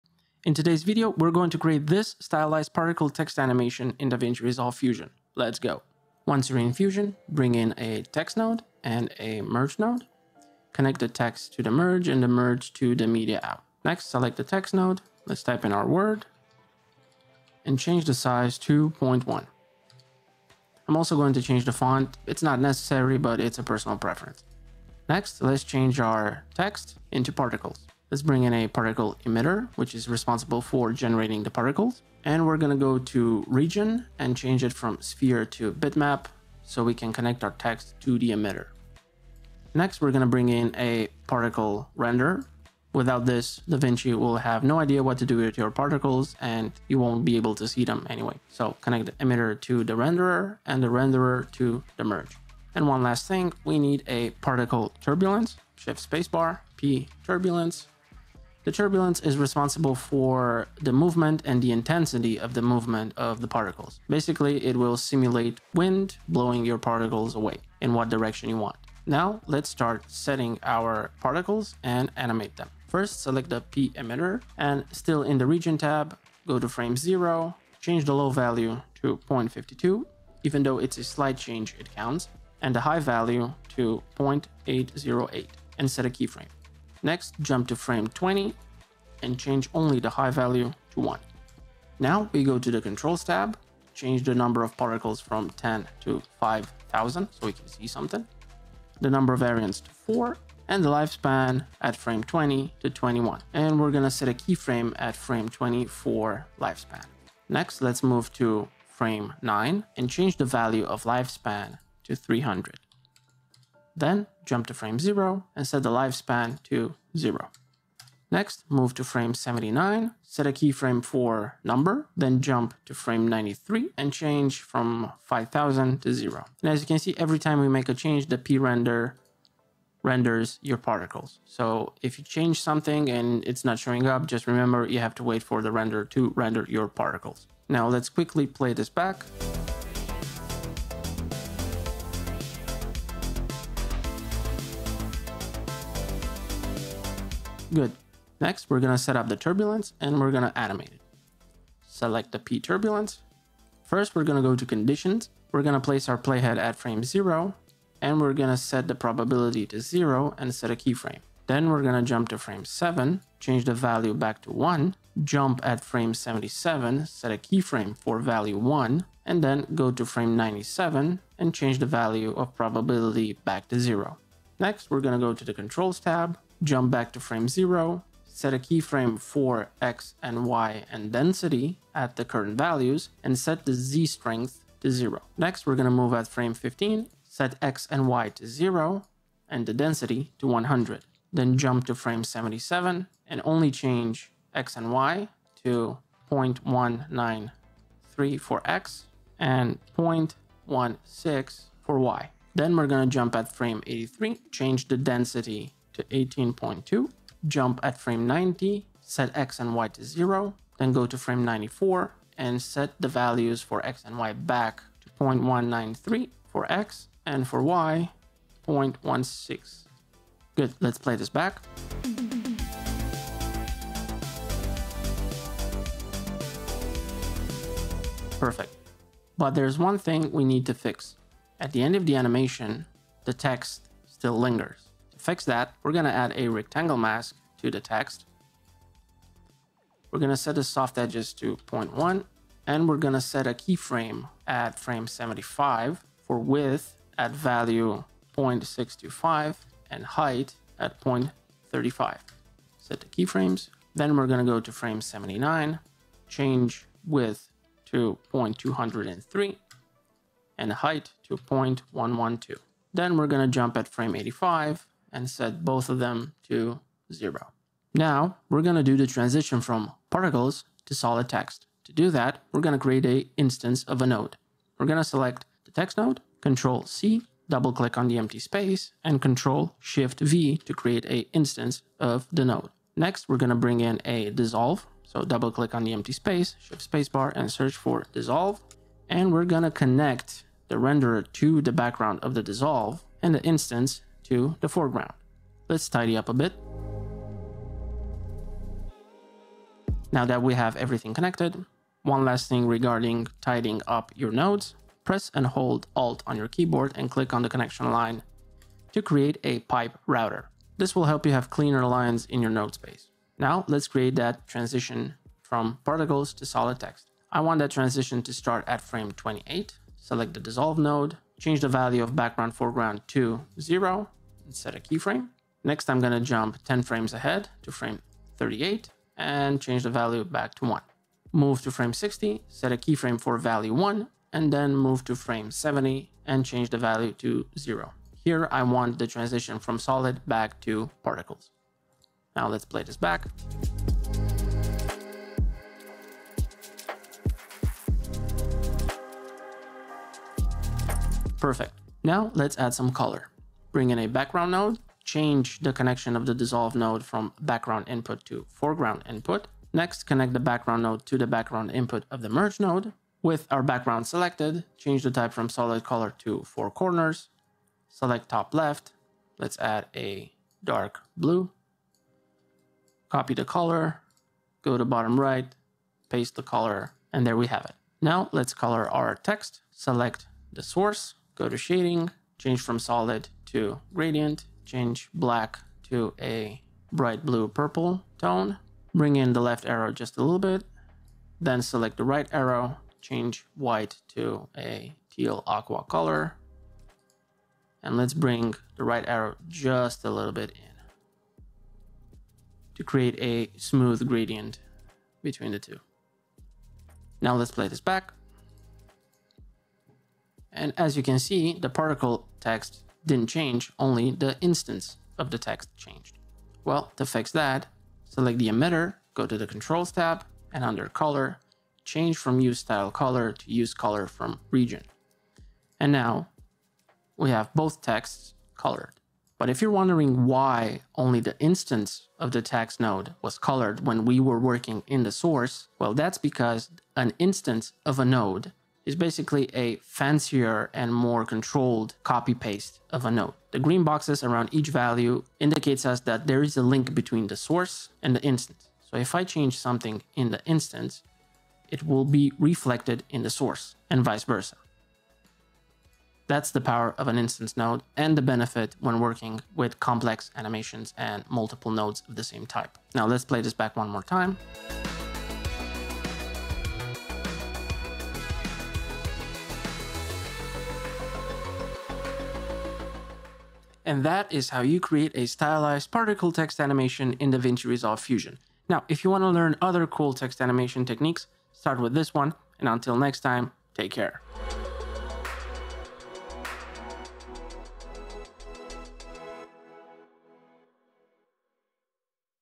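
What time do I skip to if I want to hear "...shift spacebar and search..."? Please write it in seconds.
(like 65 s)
286 s.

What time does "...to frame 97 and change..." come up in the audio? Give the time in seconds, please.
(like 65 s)
169 s.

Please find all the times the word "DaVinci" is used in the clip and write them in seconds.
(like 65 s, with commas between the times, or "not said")
4 s, 43 s, 477 s.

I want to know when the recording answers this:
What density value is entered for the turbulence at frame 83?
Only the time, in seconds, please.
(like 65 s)
206 s.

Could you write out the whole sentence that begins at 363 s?
With our background selected, change the type from solid color to four corners.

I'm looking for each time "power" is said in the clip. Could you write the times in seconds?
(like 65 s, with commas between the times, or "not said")
456 s.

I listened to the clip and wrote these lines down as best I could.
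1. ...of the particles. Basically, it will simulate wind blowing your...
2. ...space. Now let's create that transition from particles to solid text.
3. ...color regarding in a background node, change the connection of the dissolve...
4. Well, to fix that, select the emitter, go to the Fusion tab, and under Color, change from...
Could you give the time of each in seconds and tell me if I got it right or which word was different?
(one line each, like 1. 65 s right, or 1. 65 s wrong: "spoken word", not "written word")
1. 63 s right
2. 312 s right
3. 352 s wrong: "bring", not "regarding"
4. 416 s wrong: "Controls", not "Fusion".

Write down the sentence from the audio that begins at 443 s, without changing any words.
The green boxes around each value indicates us that there is a link between the source and the instance.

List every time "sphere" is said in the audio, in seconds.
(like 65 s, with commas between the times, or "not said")
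35 s.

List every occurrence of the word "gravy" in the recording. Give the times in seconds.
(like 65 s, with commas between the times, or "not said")
not said.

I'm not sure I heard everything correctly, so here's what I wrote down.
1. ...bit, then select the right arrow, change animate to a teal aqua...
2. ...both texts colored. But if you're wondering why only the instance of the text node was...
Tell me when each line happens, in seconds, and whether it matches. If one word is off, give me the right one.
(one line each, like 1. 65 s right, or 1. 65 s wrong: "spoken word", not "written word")
1. 390 s wrong: "white", not "animate"
2. 427 s right.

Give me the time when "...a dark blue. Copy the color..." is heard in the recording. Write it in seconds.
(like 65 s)
369 s.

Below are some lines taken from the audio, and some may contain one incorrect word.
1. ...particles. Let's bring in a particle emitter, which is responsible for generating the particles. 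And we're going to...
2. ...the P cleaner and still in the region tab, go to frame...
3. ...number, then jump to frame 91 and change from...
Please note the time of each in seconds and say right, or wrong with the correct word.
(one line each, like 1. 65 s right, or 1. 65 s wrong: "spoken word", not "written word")
1. 27 s right
2. 73 s wrong: "emitter", not "cleaner"
3. 121 s wrong: "93", not "91".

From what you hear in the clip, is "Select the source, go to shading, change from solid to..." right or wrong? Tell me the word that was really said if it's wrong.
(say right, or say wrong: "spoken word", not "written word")
right.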